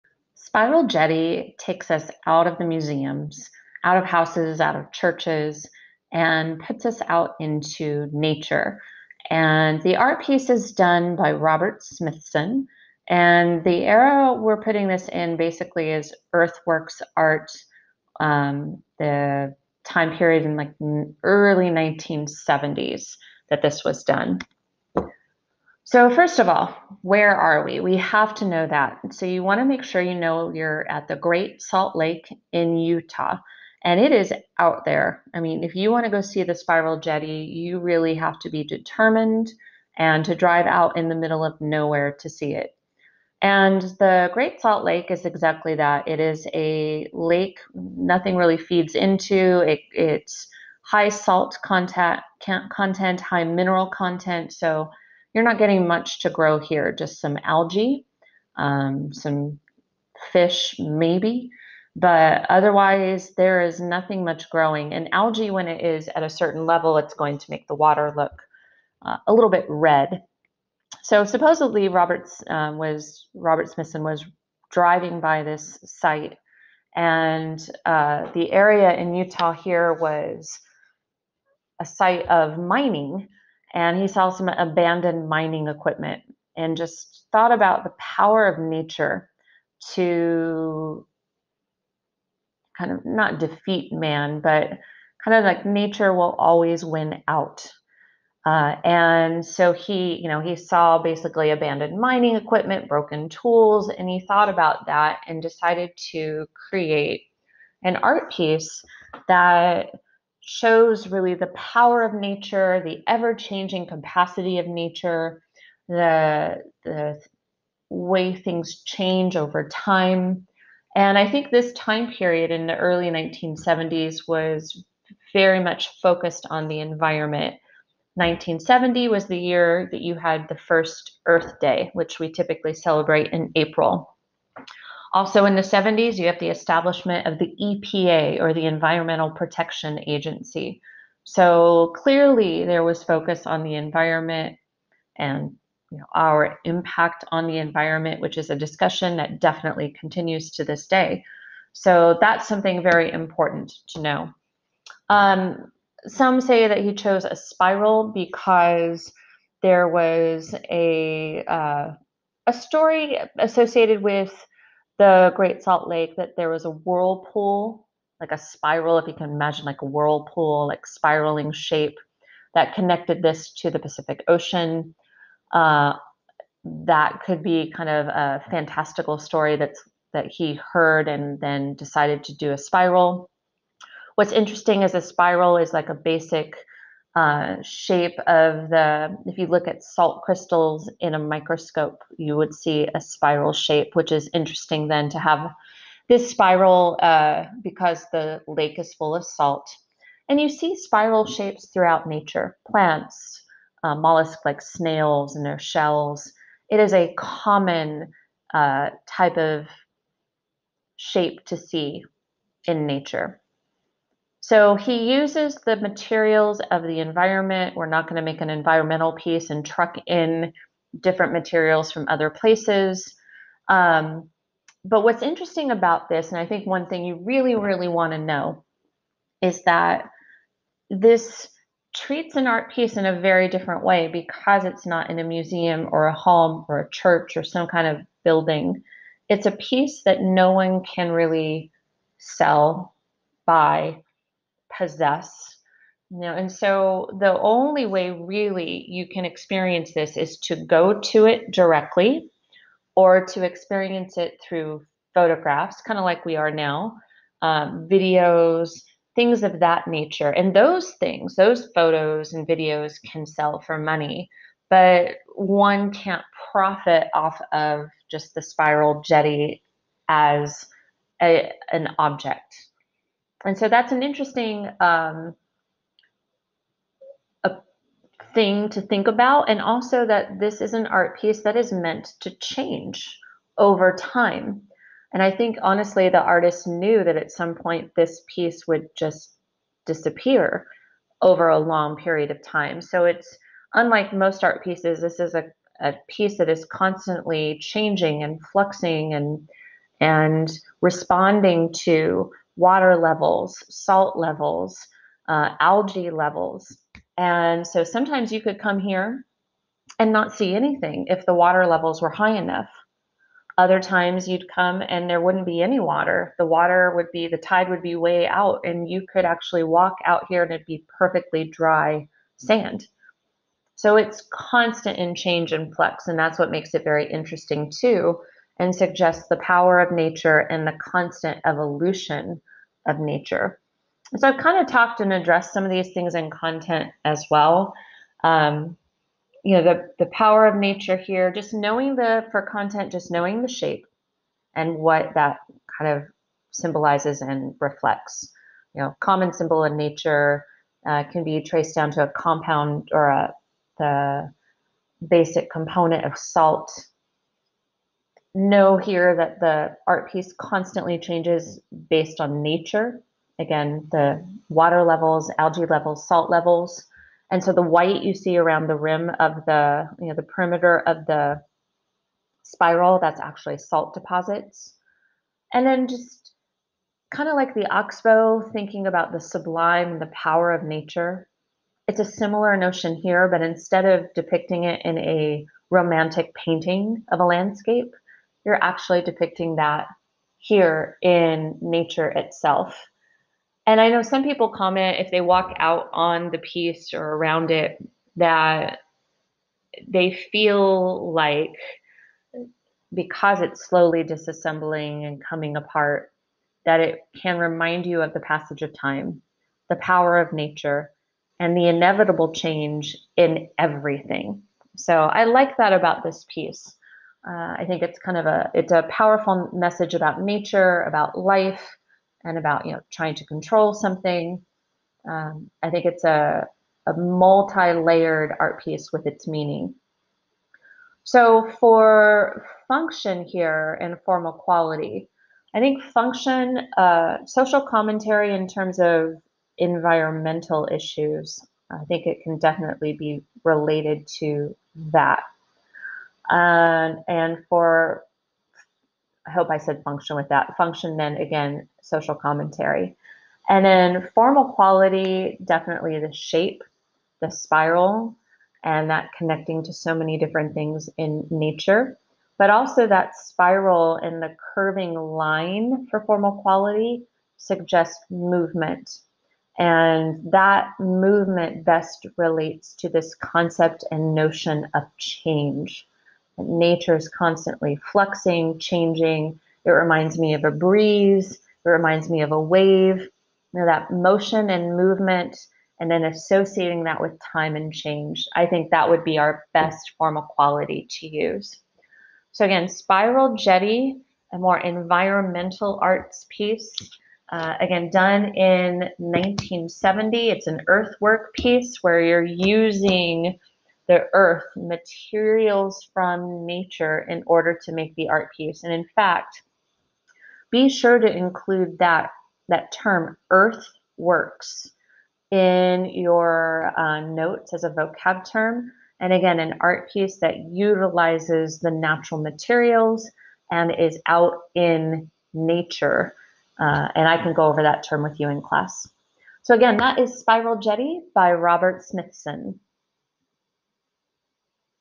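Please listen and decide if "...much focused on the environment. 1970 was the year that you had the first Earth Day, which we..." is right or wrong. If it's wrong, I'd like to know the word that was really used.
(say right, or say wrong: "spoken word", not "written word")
right.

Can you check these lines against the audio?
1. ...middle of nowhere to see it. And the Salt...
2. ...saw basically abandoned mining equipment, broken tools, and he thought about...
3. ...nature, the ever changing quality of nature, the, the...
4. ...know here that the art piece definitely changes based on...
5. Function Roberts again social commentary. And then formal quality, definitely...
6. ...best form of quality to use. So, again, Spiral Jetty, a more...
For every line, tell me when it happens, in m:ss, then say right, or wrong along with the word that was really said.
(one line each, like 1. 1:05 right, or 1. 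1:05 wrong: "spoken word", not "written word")
1. 0:41 wrong: "Great", not "Salt"
2. 1:40 right
3. 1:52 wrong: "capacity", not "quality"
4. 5:58 wrong: "constantly", not "definitely"
5. 7:30 wrong: "Then", not "Roberts"
6. 8:09 right.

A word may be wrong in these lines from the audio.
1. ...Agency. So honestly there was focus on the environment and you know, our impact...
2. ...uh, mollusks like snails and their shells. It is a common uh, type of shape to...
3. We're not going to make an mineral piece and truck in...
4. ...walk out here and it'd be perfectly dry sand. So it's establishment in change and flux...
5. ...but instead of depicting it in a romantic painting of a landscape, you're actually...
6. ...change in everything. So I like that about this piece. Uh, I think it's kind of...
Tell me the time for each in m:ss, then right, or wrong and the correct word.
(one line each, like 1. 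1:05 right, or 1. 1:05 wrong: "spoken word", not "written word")
1. 2:20 wrong: "clearly", not "honestly"
2. 3:23 right
3. 3:37 wrong: "environmental", not "mineral"
4. 5:19 wrong: "constant", not "establishment"
5. 6:23 right
6. 6:52 right.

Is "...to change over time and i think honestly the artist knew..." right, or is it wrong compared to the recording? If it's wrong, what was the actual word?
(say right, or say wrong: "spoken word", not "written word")
right.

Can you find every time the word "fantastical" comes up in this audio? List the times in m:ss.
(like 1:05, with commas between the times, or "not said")
2:58.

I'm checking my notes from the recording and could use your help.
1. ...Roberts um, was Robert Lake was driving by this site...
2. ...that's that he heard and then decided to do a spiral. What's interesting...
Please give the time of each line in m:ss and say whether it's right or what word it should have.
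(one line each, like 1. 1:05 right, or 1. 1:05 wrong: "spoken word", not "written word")
1. 1:11 wrong: "Smithson", not "Lake"
2. 2:59 right.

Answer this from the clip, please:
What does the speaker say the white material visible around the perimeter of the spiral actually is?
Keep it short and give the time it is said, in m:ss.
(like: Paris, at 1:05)
Salt deposits, at 6:13.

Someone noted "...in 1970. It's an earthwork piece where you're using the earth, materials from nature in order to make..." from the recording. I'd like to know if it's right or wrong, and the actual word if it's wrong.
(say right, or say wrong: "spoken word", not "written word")
right.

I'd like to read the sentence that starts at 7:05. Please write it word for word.
Um, I think it's a a multi-layered art piece with its meaning.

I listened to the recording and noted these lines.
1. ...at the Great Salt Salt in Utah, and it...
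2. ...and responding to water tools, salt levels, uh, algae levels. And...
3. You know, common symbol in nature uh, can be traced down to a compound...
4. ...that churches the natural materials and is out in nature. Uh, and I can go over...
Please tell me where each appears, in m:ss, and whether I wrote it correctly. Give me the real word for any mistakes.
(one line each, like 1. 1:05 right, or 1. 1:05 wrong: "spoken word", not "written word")
1. 0:30 wrong: "Lake", not "Salt"
2. 4:59 wrong: "levels", not "tools"
3. 5:48 right
4. 8:40 wrong: "utilizes", not "churches".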